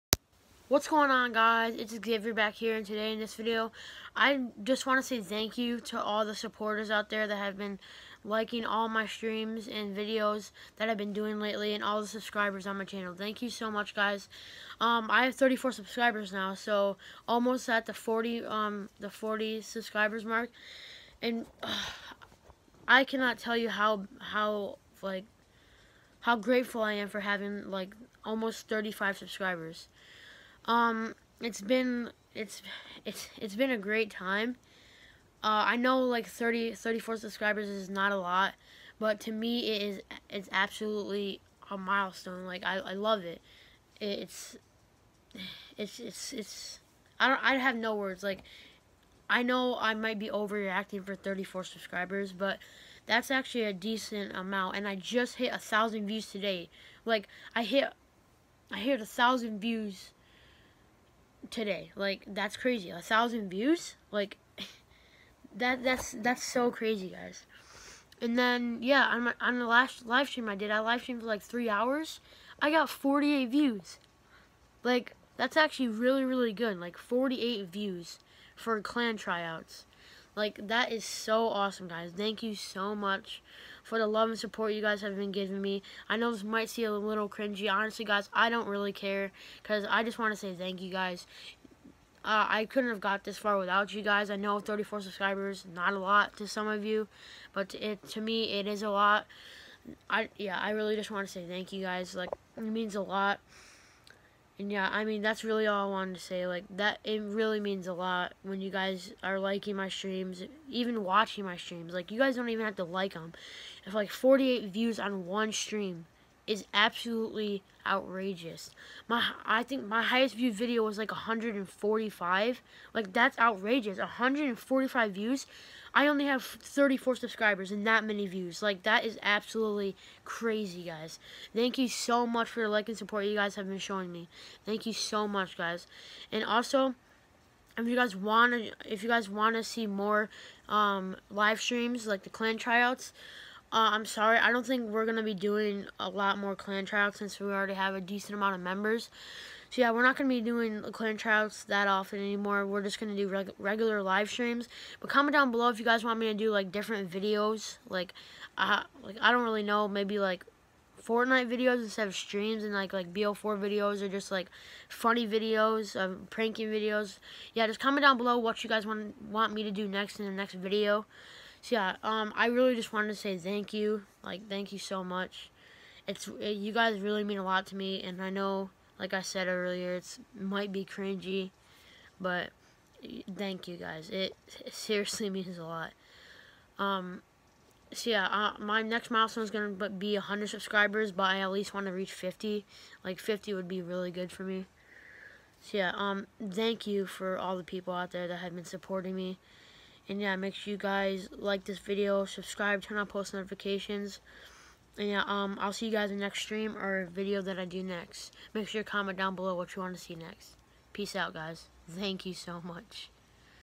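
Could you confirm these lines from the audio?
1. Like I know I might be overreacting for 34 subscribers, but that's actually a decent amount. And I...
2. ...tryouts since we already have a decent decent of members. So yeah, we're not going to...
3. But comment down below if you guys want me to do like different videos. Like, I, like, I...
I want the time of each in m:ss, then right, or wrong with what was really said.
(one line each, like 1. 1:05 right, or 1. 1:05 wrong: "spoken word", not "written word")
1. 0:48 right
2. 2:26 wrong: "amount", not "decent"
3. 2:34 right.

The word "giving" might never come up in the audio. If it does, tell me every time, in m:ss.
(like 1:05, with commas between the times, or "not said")
1:25.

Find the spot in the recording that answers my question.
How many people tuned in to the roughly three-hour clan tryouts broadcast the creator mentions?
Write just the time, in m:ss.
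1:12.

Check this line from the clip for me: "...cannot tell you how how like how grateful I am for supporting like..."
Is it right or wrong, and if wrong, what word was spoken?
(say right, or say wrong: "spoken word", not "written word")
wrong: "having", not "supporting".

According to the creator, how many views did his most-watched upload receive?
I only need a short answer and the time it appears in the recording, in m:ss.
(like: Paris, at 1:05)
145, at 2:00.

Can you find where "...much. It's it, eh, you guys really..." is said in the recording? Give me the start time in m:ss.
2:55.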